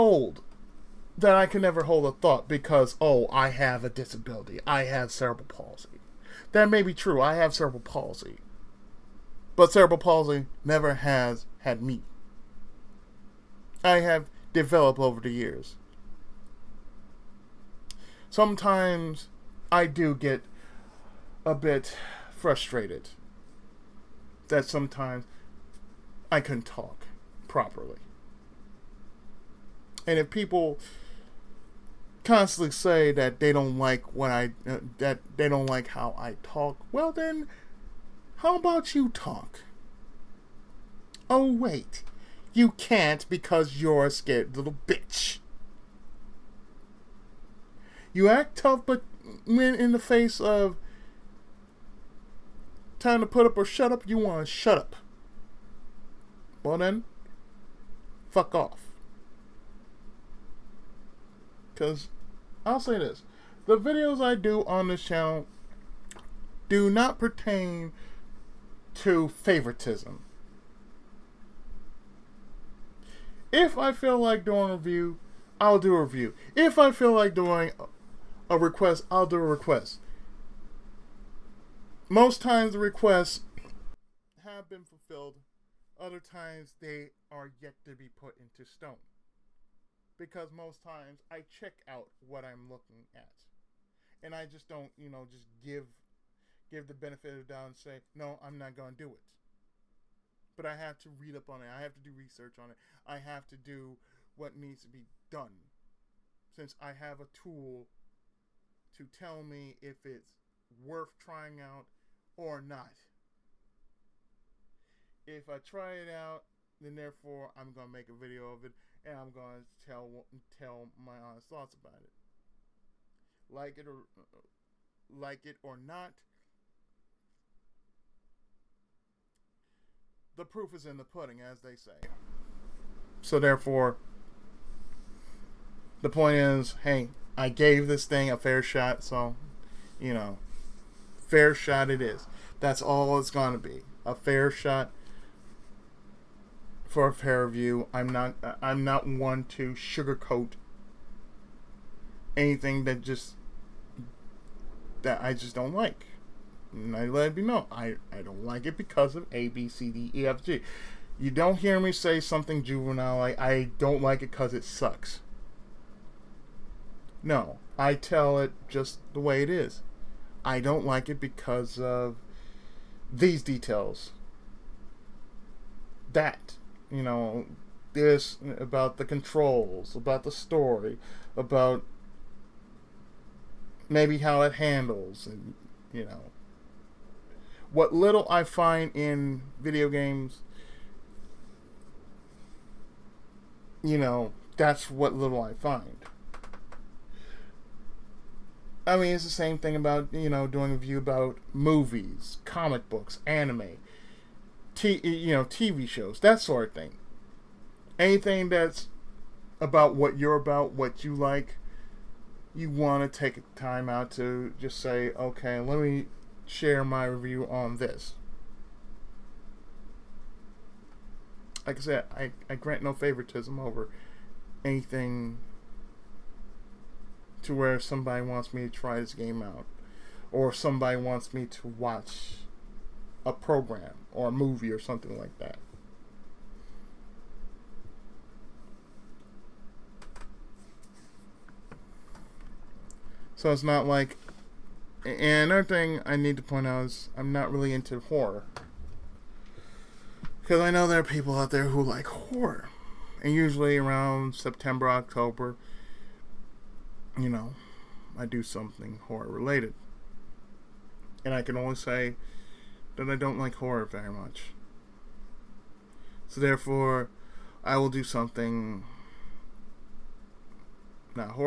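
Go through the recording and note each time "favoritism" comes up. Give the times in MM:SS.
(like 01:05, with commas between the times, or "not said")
01:09, 03:42.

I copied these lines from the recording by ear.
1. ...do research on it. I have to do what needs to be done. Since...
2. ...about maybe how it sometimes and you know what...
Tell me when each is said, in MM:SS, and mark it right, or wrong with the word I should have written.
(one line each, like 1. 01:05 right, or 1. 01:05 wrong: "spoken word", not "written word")
1. 01:41 right
2. 03:01 wrong: "handles", not "sometimes".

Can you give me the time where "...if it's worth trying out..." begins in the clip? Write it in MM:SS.
01:49.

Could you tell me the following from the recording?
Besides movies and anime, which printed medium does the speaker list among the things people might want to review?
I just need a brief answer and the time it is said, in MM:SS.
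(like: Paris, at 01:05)
comic books, at 03:22.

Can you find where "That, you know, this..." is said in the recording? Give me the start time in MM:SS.
02:56.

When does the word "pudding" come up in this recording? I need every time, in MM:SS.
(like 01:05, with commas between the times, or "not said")
02:11.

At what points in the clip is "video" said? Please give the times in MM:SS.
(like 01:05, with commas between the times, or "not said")
01:03, 01:58, 03:09.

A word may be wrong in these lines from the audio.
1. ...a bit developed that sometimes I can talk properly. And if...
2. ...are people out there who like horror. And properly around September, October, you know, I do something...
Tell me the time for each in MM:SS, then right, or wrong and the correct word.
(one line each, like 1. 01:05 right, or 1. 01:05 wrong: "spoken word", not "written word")
1. 00:21 wrong: "frustrated", not "developed"
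2. 04:10 wrong: "usually", not "properly".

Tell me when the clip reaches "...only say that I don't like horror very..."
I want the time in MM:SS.
04:21.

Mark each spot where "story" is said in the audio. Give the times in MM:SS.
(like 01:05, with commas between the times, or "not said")
03:00.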